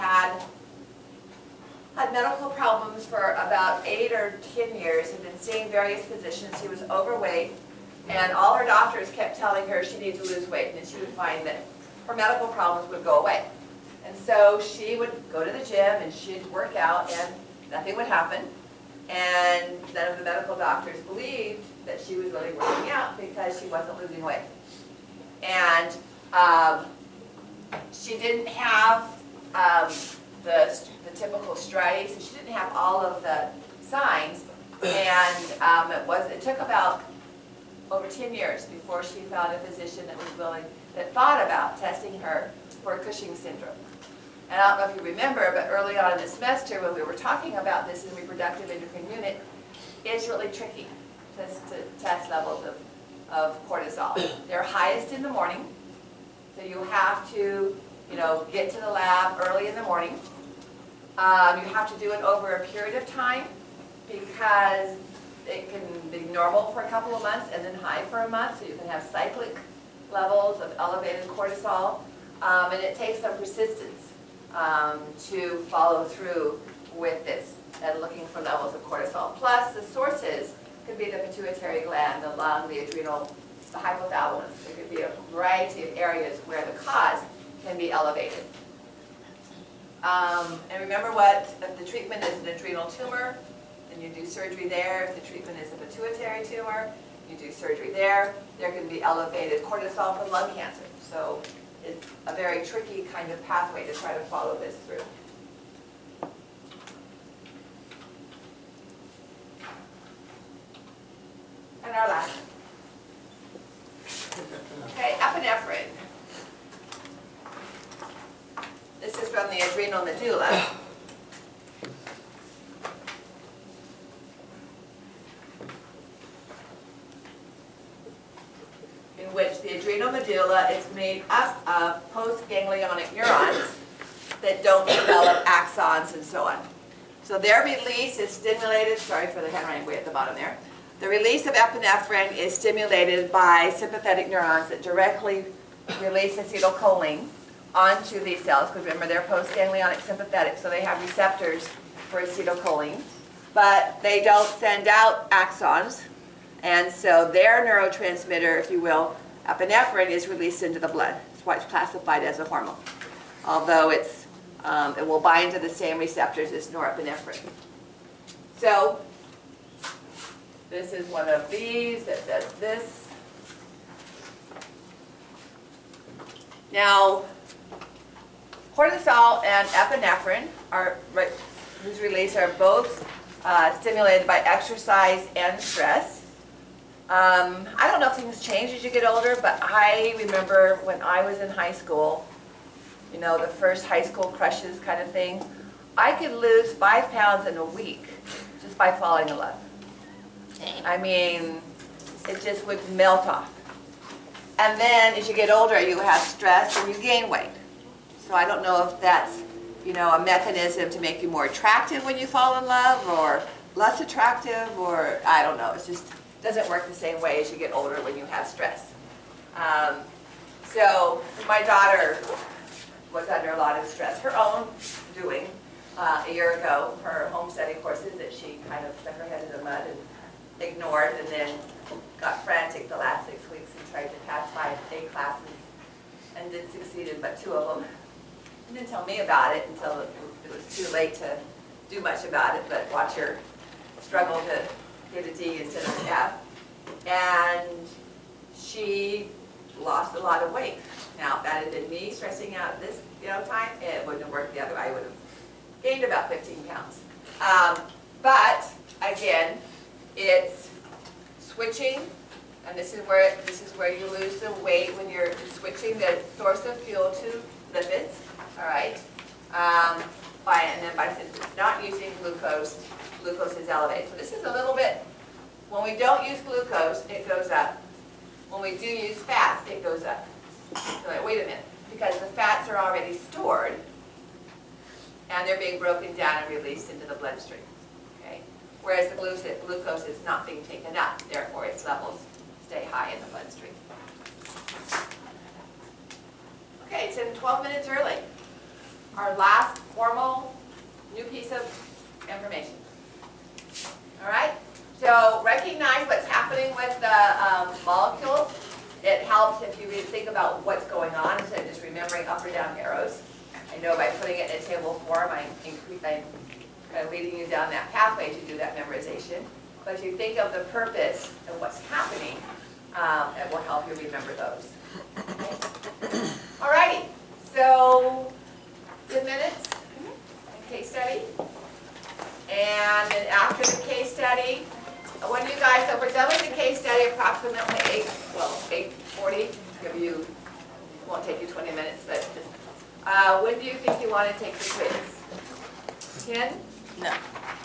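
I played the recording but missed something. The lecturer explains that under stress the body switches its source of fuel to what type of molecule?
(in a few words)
lipids.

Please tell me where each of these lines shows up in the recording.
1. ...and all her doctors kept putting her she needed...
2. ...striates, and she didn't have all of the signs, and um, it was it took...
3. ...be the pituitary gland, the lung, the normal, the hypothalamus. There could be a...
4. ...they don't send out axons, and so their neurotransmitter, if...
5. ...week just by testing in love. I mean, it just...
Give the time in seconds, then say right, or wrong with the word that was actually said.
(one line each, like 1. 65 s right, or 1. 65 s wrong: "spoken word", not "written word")
1. 8 s wrong: "telling", not "putting"
2. 31 s right
3. 80 s wrong: "adrenal", not "normal"
4. 154 s right
5. 197 s wrong: "falling", not "testing".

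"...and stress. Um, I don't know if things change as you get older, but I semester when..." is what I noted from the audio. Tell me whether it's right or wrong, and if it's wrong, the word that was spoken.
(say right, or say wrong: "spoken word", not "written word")
wrong: "remember", not "semester".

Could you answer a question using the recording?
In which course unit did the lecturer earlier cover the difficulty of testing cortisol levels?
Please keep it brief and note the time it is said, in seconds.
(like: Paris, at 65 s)
reproductive endocrine unit, at 48 s.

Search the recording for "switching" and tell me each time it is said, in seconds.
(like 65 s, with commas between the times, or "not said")
261 s, 265 s.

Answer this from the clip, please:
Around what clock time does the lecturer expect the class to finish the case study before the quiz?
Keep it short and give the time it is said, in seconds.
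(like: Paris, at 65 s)
8:40, at 338 s.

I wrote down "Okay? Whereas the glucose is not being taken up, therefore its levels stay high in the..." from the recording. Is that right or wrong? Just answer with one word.
right.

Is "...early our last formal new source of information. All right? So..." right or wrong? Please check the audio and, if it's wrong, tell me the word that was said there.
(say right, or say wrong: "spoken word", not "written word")
wrong: "piece", not "source".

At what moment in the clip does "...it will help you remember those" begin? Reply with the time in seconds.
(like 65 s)
323 s.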